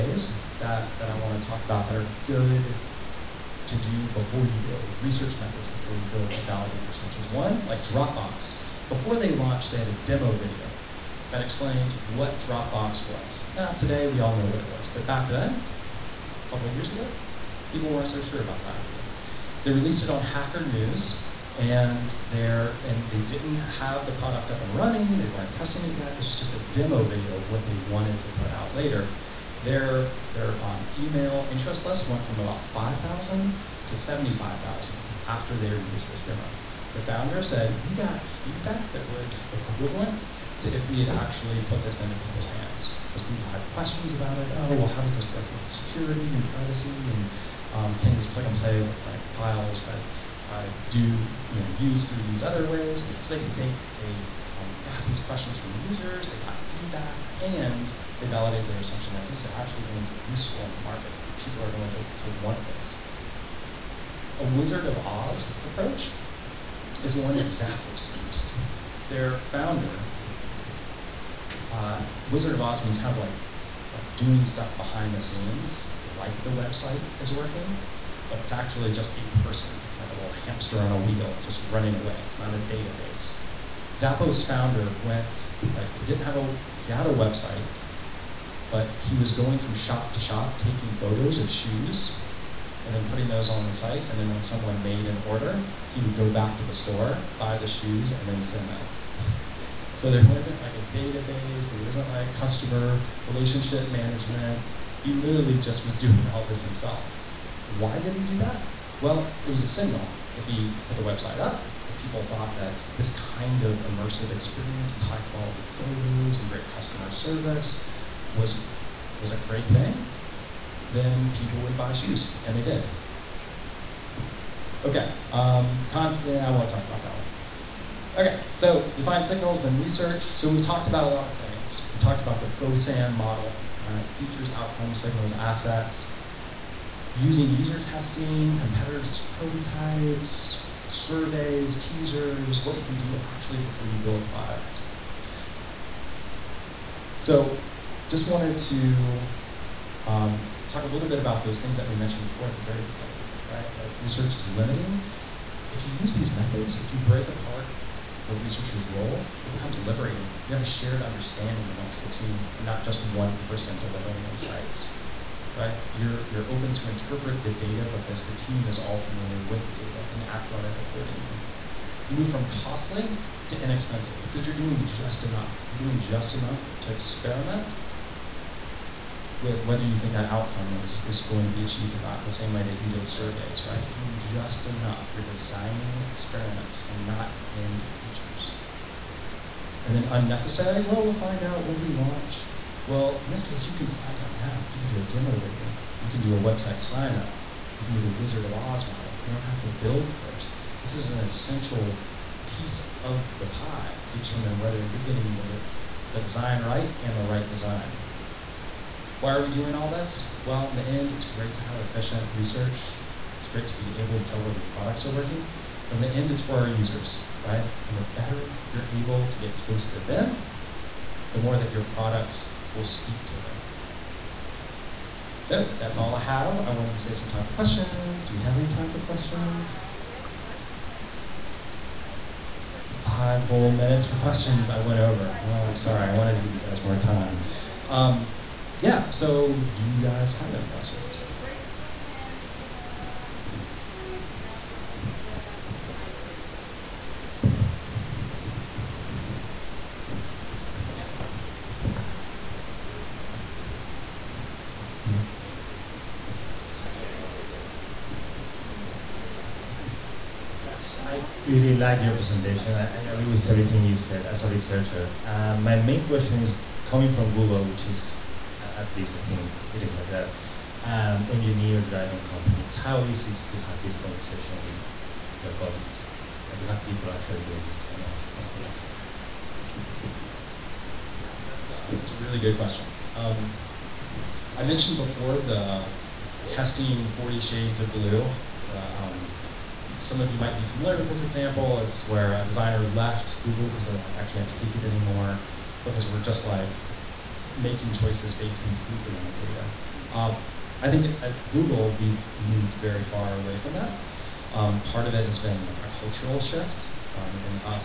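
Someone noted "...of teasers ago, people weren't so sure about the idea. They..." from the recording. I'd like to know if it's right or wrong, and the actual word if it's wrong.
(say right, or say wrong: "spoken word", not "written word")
wrong: "years", not "teasers".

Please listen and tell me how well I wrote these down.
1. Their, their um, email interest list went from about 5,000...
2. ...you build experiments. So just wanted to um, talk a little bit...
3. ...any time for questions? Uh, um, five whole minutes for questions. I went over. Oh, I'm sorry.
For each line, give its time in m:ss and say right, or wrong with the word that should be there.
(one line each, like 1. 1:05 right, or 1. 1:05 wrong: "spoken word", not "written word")
1. 0:29 right
2. 2:23 wrong: "products", not "experiments"
3. 3:48 right.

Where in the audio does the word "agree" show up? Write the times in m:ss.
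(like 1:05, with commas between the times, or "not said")
4:23.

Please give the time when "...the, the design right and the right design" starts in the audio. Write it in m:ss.
3:25.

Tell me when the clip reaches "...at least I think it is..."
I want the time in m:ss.
4:28.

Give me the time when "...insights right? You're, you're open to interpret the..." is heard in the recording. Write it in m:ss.
2:44.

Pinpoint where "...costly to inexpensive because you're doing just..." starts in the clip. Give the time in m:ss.
2:52.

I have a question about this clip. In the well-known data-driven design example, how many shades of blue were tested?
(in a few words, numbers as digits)
40.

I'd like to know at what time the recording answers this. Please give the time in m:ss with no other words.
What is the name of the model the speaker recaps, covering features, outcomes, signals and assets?
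2:12.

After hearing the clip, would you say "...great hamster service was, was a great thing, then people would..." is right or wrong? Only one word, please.
wrong.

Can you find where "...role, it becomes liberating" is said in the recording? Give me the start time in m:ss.
2:38.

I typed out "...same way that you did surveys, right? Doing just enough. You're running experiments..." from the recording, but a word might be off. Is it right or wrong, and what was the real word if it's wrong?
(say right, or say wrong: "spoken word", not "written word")
wrong: "designing", not "running".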